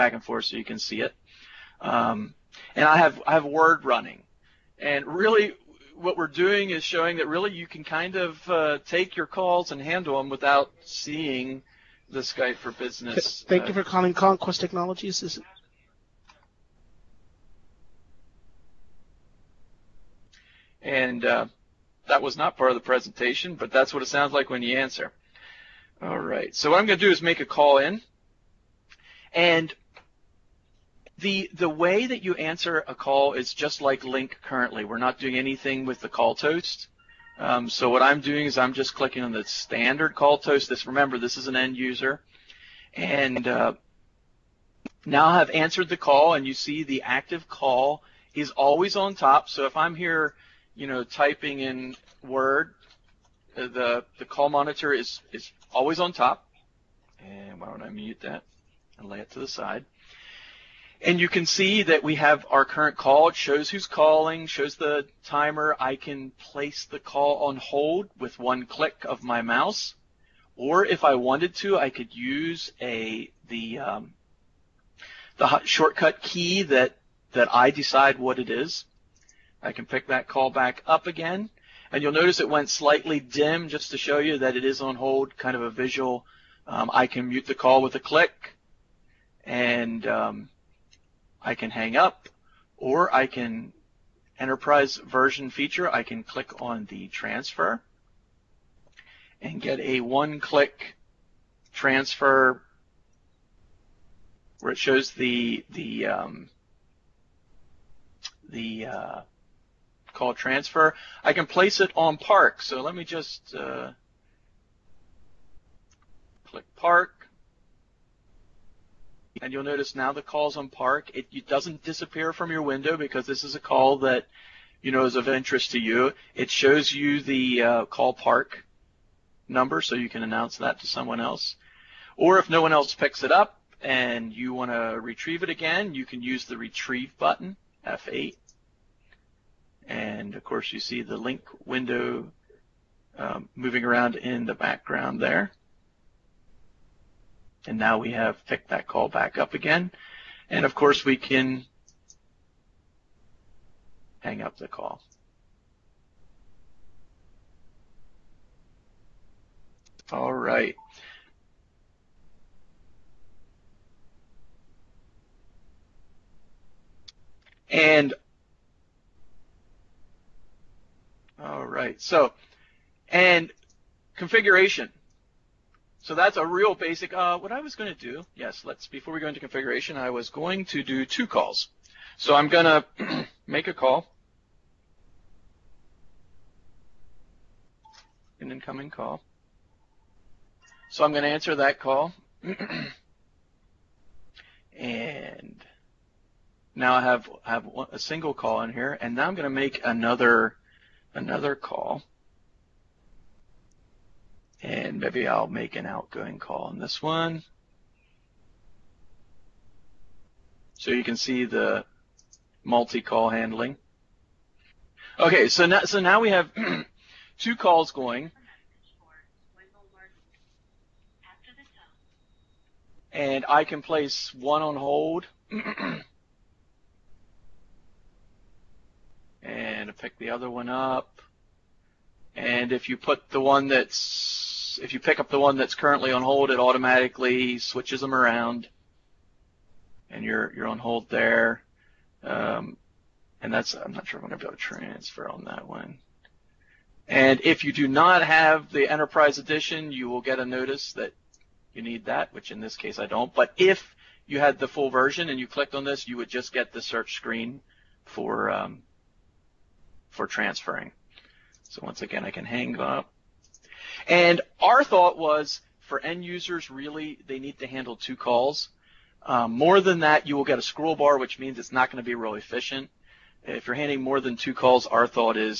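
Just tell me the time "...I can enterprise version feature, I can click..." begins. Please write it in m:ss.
1:33.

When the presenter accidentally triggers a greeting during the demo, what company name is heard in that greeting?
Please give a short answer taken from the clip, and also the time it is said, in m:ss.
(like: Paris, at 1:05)
Conquest Technologies, at 0:14.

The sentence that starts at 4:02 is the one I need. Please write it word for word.
Um, and that's I'm not sure I'm going to be able to transfer on that one.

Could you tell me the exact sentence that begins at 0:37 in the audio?
Um, so what I'm doing is I'm just clicking on the standard call toast.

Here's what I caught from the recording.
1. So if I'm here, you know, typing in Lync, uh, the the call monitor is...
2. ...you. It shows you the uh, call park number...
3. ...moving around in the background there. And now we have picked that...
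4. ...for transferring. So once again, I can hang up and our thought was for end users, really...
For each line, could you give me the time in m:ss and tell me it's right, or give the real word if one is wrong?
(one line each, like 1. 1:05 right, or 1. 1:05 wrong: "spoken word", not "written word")
1. 0:49 wrong: "Word", not "Lync"
2. 2:05 right
3. 2:23 right
4. 4:20 right.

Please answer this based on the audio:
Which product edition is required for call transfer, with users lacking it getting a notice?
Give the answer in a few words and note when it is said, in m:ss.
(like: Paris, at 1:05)
Enterprise Edition, at 4:08.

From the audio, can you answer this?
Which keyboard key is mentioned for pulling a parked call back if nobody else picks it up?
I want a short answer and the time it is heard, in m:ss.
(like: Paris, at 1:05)
F8, at 2:17.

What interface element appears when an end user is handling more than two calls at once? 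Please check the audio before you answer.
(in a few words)
scroll bar.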